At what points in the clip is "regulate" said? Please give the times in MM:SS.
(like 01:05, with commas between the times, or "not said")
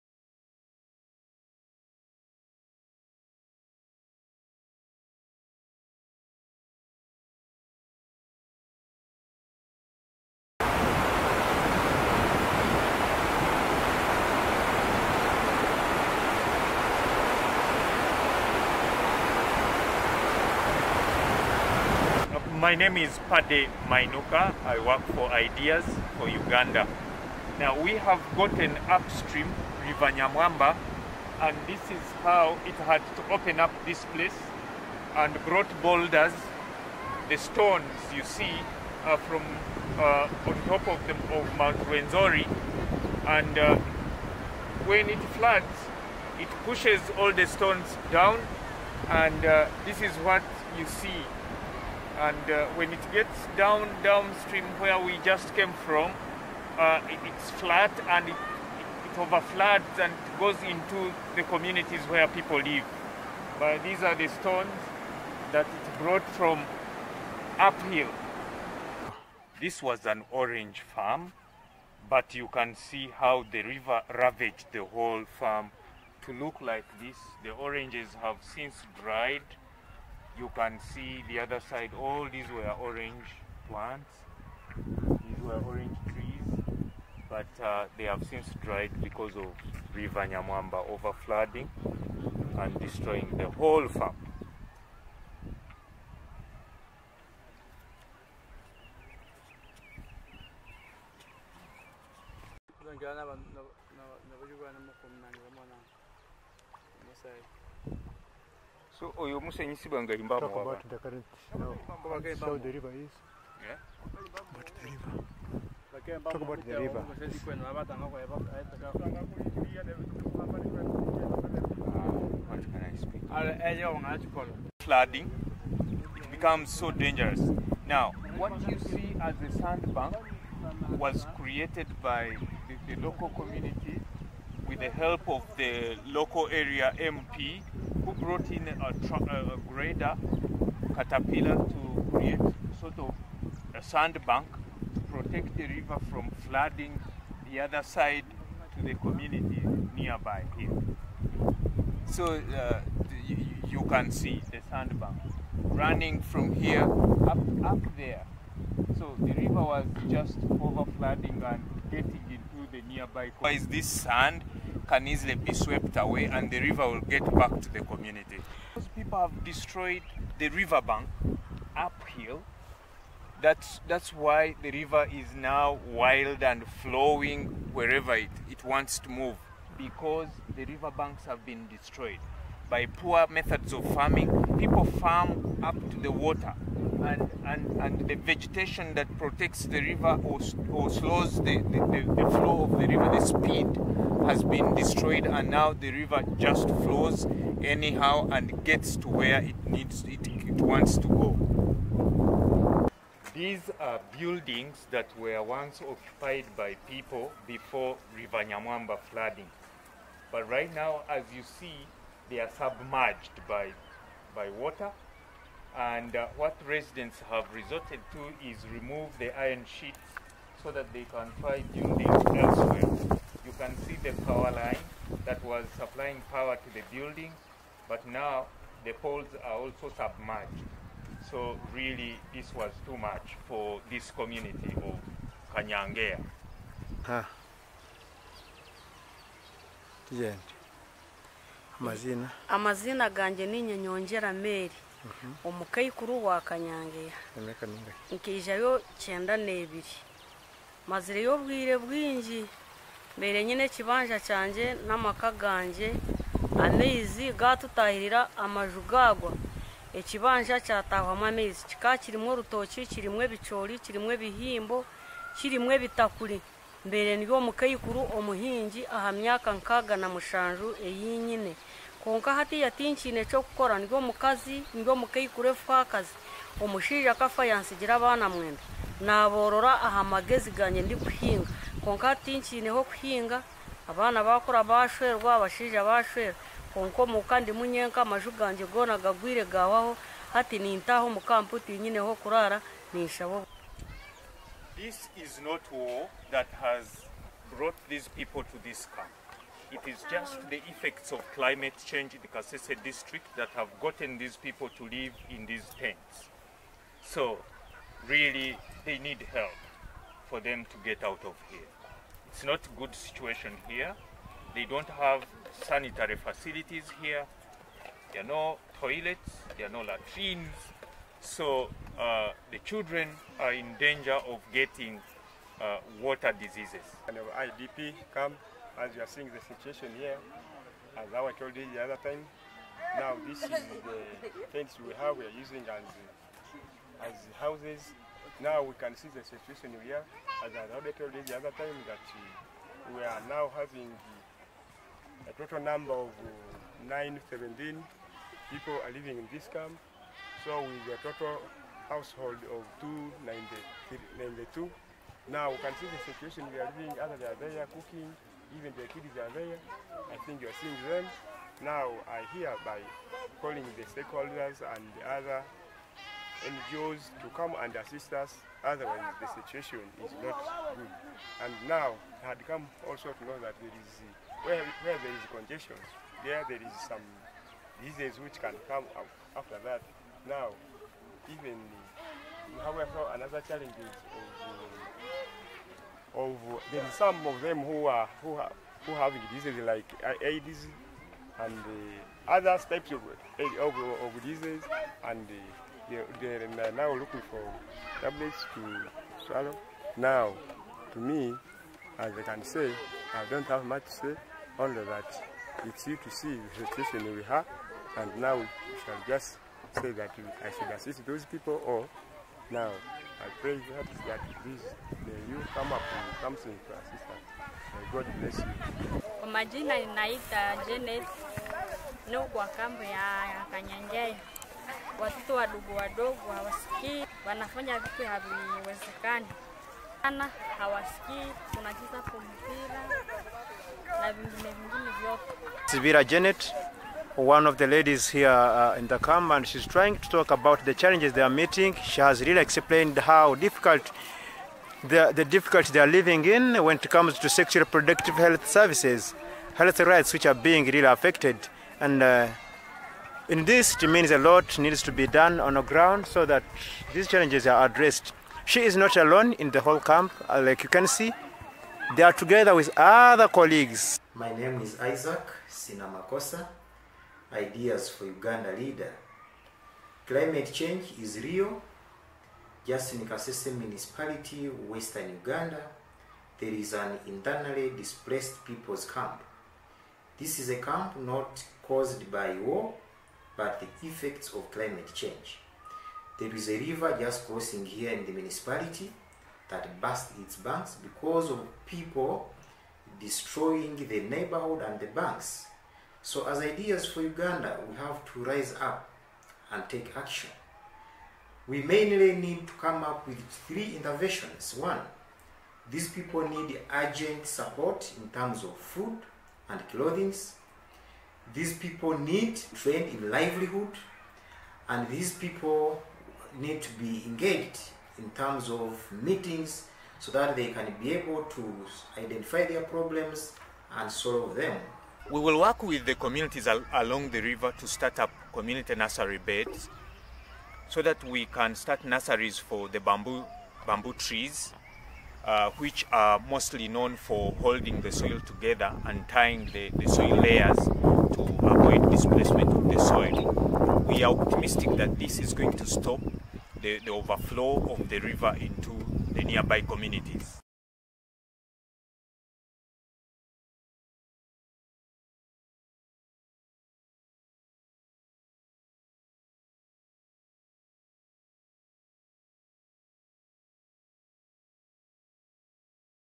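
not said.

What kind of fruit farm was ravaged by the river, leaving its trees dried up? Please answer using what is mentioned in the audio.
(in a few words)
Orange farm.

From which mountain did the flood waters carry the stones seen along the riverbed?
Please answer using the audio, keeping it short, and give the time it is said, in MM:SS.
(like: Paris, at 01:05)
Mount Rwenzori, at 00:41.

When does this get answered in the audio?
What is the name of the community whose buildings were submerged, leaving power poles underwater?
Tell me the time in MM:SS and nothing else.
03:55.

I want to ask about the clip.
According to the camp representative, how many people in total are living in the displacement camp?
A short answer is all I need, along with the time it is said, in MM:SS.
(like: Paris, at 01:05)
917, at 05:46.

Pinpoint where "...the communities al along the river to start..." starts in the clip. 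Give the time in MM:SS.
08:45.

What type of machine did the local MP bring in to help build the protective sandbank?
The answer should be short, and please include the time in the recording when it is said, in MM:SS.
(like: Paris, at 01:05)
Grader caterpillar, at 02:19.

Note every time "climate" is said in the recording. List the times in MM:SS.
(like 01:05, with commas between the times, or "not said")
05:01, 07:50, 08:04.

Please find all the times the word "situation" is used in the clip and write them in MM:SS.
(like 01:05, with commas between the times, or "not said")
05:12, 05:29, 05:39, 05:56, 06:09, 06:46.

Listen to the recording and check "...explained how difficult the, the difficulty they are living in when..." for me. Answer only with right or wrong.
right.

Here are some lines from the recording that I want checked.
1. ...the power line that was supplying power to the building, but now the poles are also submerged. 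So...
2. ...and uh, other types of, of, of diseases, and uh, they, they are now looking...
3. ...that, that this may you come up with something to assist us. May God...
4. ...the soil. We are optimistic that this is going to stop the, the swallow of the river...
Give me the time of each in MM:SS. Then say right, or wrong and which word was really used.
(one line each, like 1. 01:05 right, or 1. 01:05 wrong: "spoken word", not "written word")
1. 03:44 right
2. 06:31 right
3. 06:53 right
4. 09:02 wrong: "overflow", not "swallow".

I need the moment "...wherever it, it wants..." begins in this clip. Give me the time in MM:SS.
02:57.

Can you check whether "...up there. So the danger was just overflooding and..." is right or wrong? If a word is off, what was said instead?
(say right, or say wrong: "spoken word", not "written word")
wrong: "river", not "danger".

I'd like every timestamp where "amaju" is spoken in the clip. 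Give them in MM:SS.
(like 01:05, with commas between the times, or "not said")
04:18, 04:48.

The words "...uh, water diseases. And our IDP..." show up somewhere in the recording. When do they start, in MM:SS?
05:25.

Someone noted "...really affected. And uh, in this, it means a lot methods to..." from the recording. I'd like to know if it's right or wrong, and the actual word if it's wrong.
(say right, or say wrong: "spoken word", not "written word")
wrong: "needs", not "methods".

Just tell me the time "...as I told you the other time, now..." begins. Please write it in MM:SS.
05:30.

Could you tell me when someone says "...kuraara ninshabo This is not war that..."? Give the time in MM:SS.
04:52.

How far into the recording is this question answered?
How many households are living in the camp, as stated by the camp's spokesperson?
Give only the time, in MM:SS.
05:52.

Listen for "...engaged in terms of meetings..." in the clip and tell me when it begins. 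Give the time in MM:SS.
08:37.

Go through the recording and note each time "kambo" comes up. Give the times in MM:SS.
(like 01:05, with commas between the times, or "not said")
07:02.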